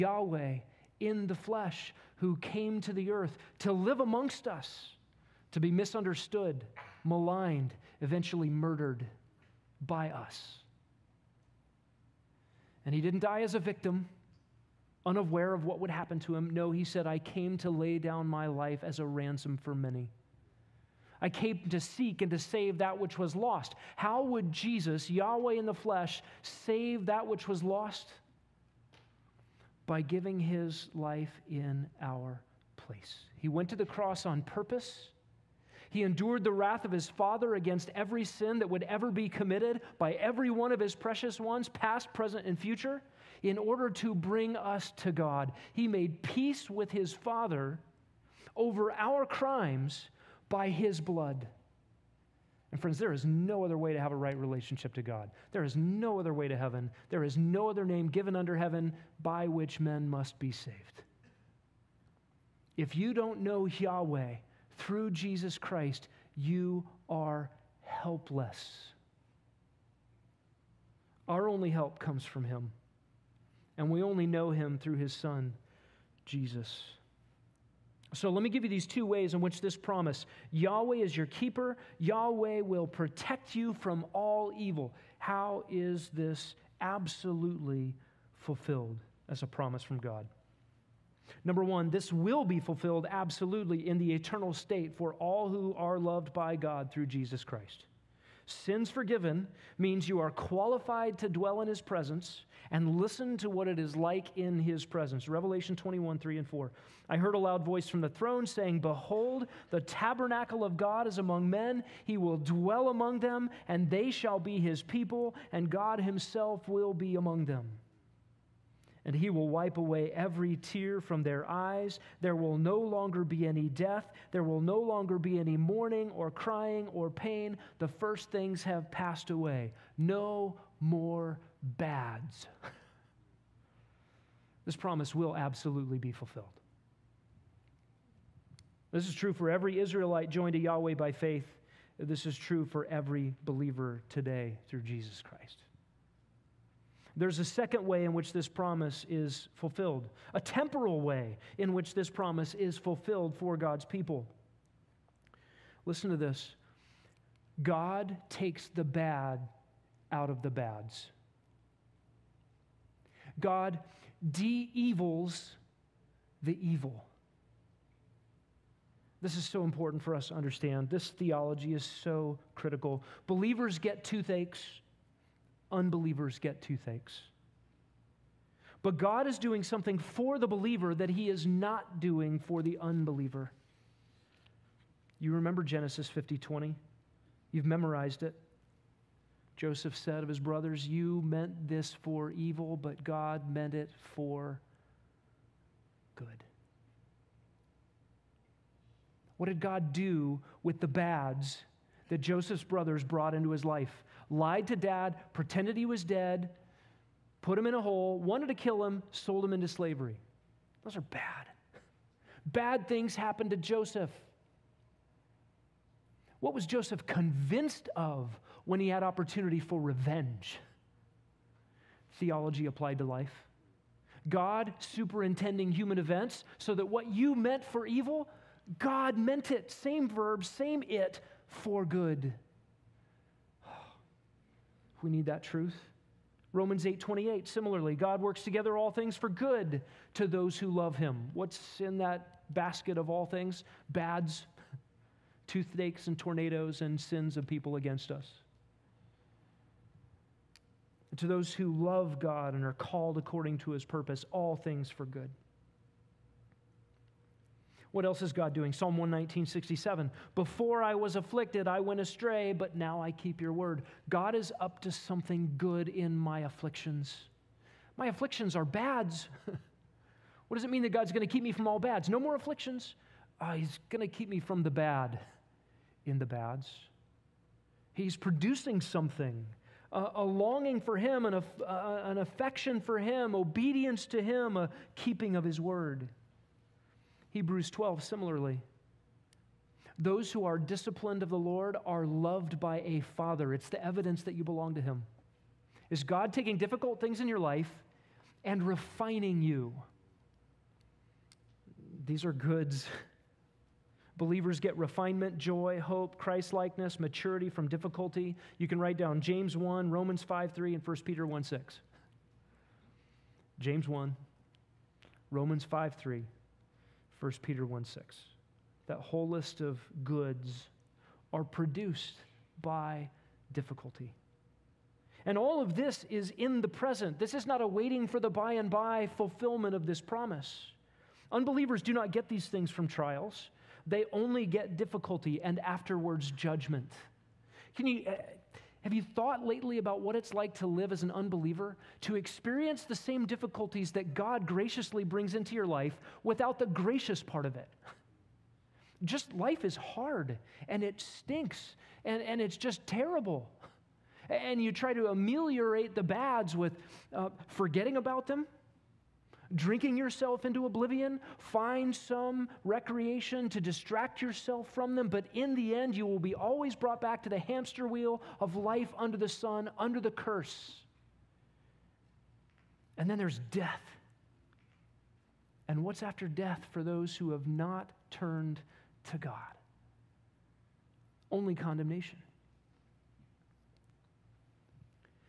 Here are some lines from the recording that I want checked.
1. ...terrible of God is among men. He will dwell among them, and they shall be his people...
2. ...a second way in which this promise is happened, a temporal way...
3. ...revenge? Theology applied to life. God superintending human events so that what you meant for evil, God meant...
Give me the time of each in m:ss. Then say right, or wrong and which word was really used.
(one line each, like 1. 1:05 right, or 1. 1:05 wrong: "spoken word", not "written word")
1. 1:49 wrong: "tabernacle", not "terrible"
2. 2:27 wrong: "fulfilled", not "happened"
3. 3:39 right.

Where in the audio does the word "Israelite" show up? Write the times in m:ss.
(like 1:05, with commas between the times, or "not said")
2:19.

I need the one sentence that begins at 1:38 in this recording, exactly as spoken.
Sins forgiven means you are qualified to dwell in his presence and listen to what it is like in his presence.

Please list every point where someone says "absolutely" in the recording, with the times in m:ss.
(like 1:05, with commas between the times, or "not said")
1:26, 1:33, 2:15.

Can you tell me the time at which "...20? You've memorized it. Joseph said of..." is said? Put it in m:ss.
3:06.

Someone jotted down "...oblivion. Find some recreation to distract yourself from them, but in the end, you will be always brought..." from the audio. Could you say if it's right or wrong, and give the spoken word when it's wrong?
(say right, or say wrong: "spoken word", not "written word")
right.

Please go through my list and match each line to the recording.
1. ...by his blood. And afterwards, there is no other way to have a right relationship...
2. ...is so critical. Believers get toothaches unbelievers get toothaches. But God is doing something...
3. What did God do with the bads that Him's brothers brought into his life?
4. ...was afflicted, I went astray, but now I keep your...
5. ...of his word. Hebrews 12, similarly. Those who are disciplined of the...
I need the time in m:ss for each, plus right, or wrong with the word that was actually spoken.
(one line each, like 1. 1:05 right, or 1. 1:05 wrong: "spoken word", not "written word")
1. 0:50 wrong: "friends", not "afterwards"
2. 2:51 right
3. 3:19 wrong: "Joseph", not "Him"
4. 4:20 right
5. 4:45 right.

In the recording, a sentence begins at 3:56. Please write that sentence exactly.
Romans 8:28 similarly God works together all things for good to those who love him.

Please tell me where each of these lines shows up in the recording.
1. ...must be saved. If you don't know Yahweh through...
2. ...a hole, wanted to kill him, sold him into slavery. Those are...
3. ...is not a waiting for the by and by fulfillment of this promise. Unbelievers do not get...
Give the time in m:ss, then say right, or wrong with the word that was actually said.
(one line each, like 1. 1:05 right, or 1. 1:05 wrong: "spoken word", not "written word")
1. 1:00 right
2. 3:27 right
3. 5:27 right.